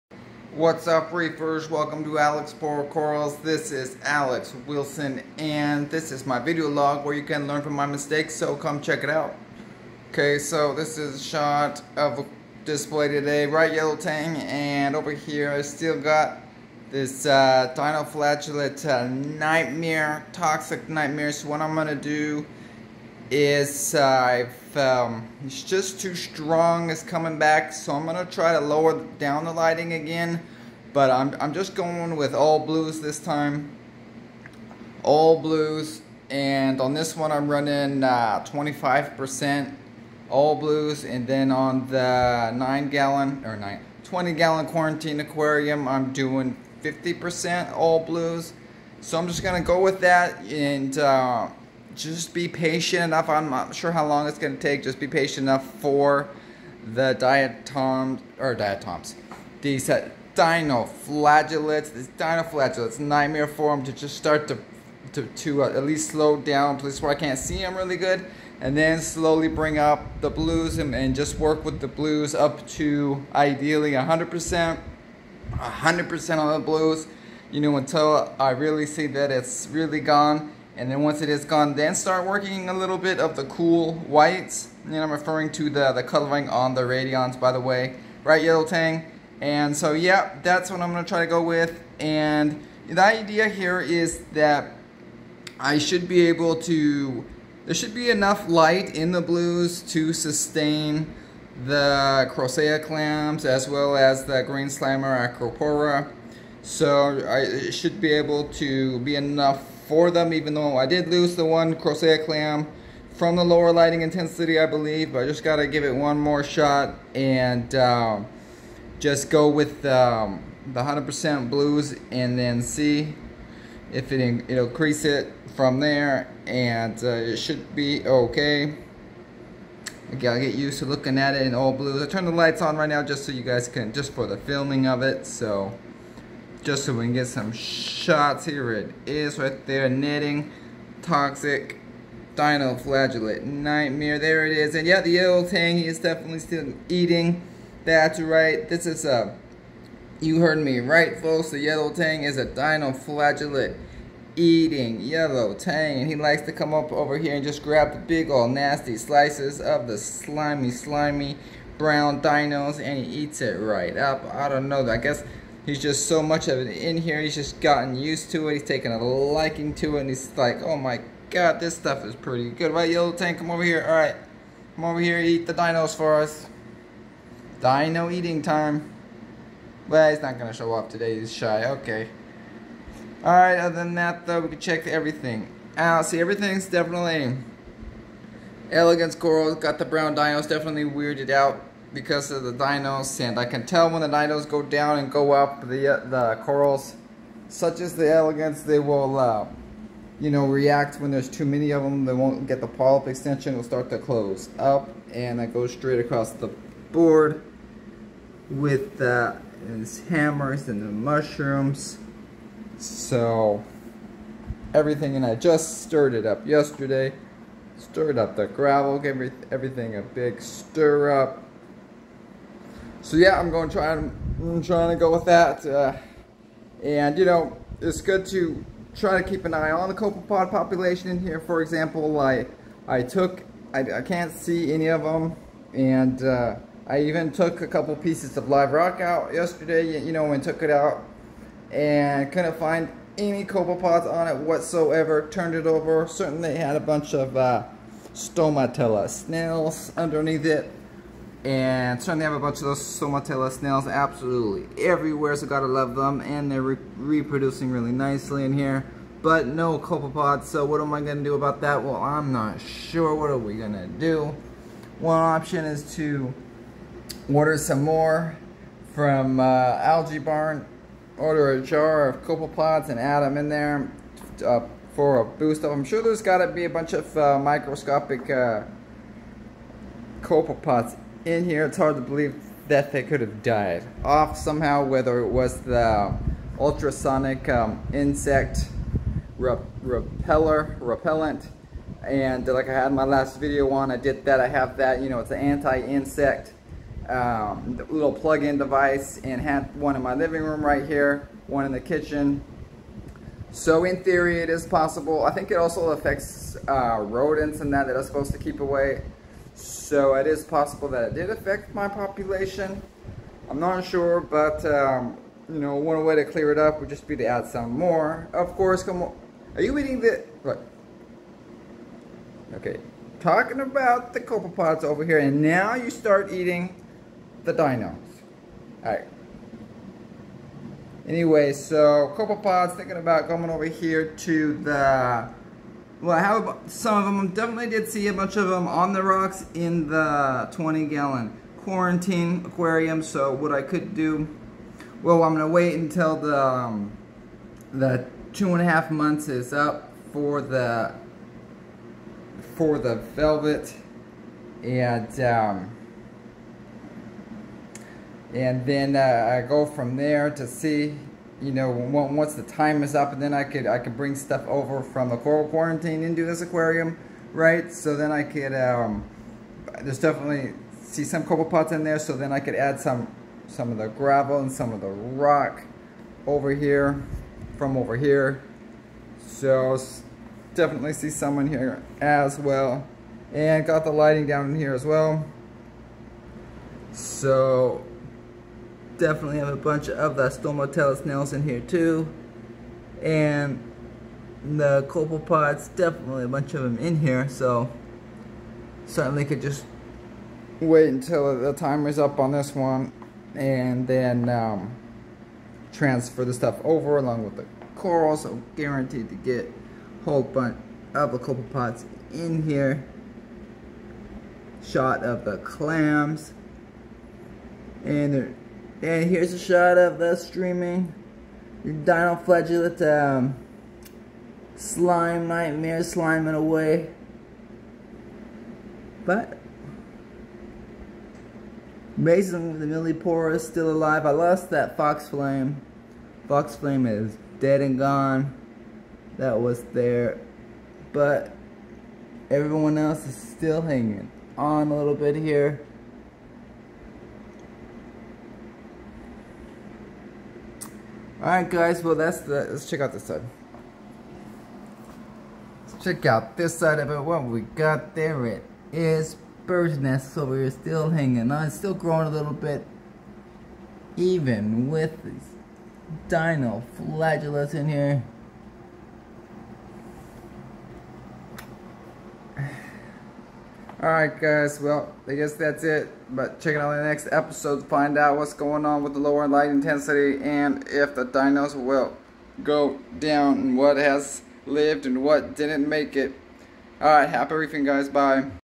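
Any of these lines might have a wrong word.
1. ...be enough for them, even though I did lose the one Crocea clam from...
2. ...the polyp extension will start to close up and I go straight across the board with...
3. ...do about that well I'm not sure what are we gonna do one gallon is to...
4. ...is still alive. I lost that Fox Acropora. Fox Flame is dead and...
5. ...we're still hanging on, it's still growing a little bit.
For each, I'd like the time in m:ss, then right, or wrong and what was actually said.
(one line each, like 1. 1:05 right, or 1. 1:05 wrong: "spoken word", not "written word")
1. 1:49 right
2. 3:22 right
3. 4:21 wrong: "option", not "gallon"
4. 7:13 wrong: "Flame", not "Acropora"
5. 7:40 right.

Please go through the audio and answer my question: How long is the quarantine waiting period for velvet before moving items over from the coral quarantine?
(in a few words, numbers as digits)
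2.5 months.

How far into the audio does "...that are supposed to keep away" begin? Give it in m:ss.
5:07.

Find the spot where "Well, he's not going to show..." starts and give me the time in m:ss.
2:59.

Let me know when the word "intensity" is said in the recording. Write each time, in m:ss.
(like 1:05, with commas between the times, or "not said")
1:54, 7:59.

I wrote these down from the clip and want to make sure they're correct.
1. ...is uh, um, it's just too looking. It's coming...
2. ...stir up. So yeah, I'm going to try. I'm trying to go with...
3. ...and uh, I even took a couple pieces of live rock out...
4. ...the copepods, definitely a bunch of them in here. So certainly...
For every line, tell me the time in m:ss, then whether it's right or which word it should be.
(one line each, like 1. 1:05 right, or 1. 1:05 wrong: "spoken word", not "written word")
1. 0:23 wrong: "strong", not "looking"
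2. 3:40 right
3. 3:55 right
4. 6:34 right.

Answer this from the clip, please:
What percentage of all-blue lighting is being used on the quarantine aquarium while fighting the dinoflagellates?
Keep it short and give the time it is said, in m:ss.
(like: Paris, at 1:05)
50%, at 0:46.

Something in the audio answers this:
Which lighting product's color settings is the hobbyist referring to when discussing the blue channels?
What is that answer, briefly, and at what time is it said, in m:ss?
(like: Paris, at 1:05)
Radiance, at 1:26.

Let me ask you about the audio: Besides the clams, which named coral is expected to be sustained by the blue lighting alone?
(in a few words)
Green Slimer Acropora.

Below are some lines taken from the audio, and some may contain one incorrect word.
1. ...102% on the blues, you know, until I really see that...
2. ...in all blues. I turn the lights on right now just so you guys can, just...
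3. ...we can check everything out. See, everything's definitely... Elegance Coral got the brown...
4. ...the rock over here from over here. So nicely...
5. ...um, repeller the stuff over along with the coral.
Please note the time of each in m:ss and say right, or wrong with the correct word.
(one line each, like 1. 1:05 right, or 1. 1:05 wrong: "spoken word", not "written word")
1. 1:15 wrong: "100", not "102"
2. 2:11 right
3. 3:04 right
4. 6:14 wrong: "definitely", not "nicely"
5. 6:44 wrong: "transfer", not "repeller".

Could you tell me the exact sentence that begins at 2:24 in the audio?
And yeah, the yellow He is definitely still eating.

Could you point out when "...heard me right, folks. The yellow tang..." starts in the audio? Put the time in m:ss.
2:30.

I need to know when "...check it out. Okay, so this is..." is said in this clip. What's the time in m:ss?
0:08.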